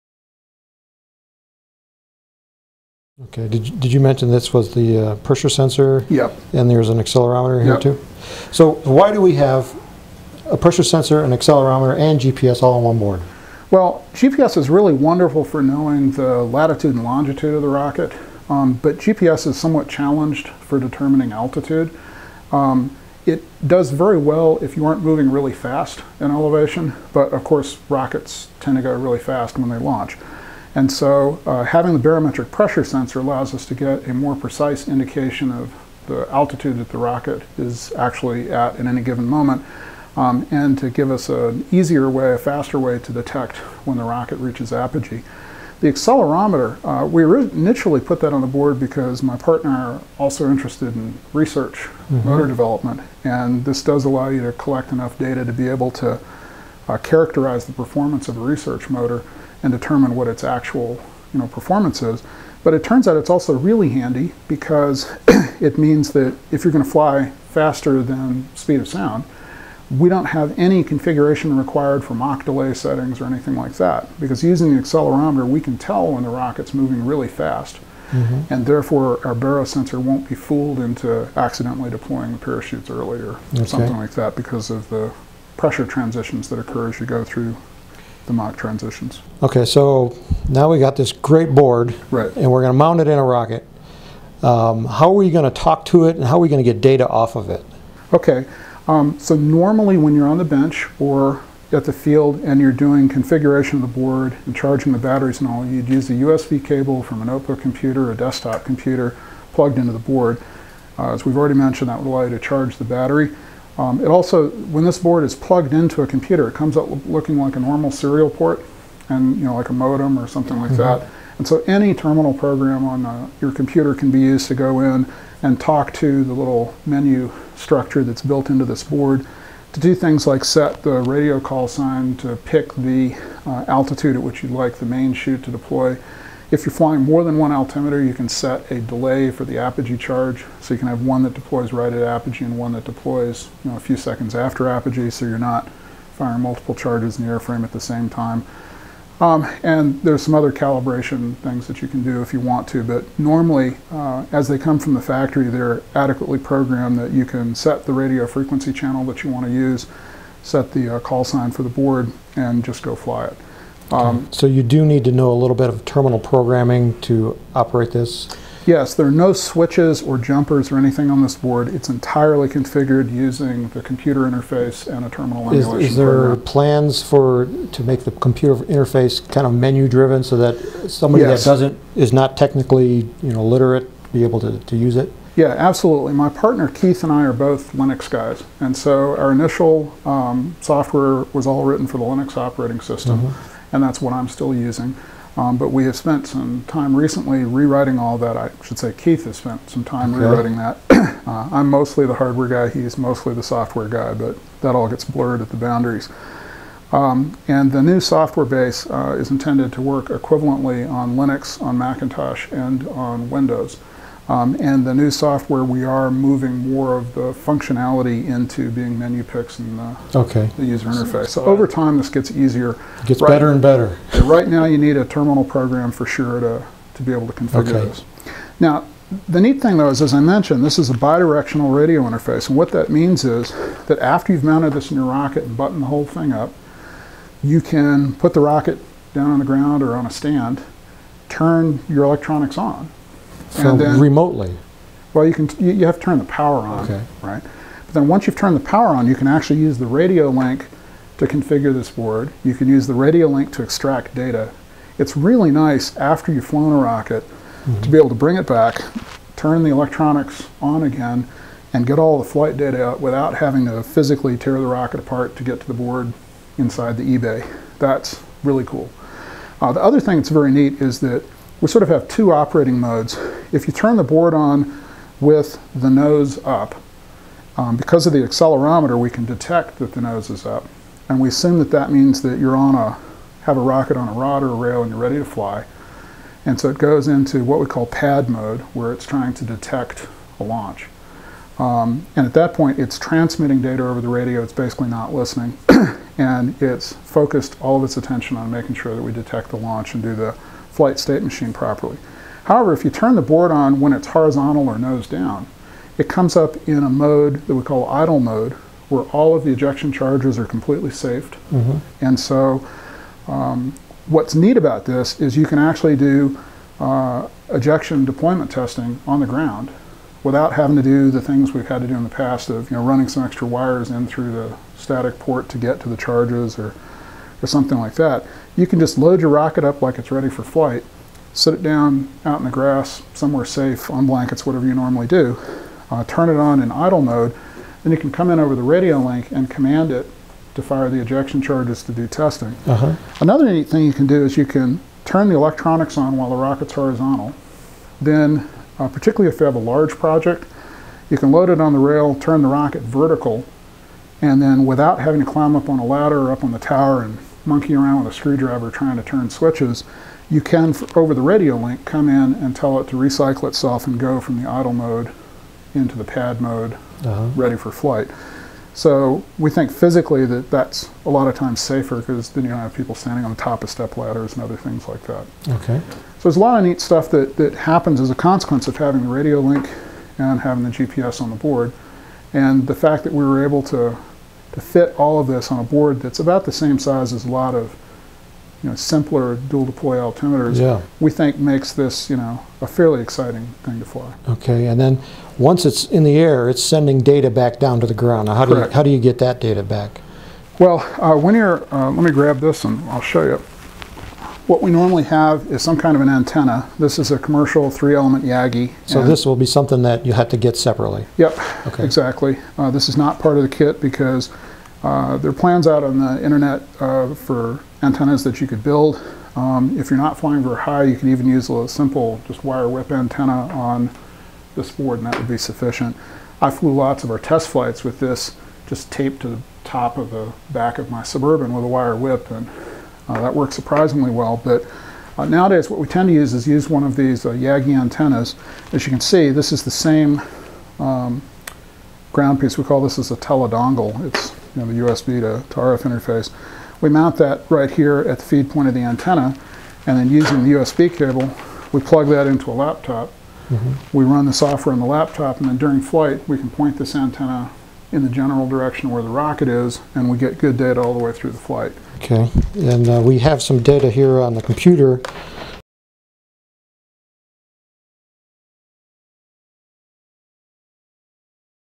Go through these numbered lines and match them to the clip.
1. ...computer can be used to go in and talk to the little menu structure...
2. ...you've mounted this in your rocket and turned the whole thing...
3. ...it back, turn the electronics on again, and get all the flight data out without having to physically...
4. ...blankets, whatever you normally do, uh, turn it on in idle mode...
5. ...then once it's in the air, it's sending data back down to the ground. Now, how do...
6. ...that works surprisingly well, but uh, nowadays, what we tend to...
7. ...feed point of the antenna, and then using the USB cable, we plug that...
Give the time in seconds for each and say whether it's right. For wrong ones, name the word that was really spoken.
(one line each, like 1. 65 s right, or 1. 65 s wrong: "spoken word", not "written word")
1. 123 s right
2. 234 s wrong: "buttoned", not "turned"
3. 258 s right
4. 334 s right
5. 394 s right
6. 433 s right
7. 448 s right.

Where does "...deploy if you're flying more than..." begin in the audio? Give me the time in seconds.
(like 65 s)
135 s.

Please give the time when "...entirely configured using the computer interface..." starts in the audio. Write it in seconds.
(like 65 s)
171 s.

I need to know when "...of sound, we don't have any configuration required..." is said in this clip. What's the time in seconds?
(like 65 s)
68 s.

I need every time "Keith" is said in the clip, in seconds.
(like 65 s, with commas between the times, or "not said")
186 s, 198 s.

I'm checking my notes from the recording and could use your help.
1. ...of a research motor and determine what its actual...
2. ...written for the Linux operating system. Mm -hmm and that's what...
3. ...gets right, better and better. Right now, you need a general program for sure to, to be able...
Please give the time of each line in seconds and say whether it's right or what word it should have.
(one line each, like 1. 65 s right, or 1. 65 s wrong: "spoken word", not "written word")
1. 58 s right
2. 191 s right
3. 223 s wrong: "terminal", not "general".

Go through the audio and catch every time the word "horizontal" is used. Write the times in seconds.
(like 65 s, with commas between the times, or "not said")
304 s, 346 s.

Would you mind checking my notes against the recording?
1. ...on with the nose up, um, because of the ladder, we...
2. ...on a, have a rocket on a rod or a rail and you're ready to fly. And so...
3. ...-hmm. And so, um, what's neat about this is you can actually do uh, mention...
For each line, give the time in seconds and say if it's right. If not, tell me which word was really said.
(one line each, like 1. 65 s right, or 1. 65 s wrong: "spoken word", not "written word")
1. 274 s wrong: "accelerometer", not "ladder"
2. 282 s right
3. 311 s wrong: "ejection", not "mention".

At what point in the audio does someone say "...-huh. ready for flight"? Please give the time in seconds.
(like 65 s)
367 s.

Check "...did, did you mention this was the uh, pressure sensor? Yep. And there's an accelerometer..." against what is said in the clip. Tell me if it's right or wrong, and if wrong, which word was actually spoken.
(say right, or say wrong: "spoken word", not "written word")
right.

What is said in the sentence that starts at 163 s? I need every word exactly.
Um, so you do need to know a little bit of terminal programming to operate this?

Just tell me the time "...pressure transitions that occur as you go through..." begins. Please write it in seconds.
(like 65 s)
85 s.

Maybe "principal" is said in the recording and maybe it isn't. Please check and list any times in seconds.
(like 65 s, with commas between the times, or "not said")
not said.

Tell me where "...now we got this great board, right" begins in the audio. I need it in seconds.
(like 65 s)
90 s.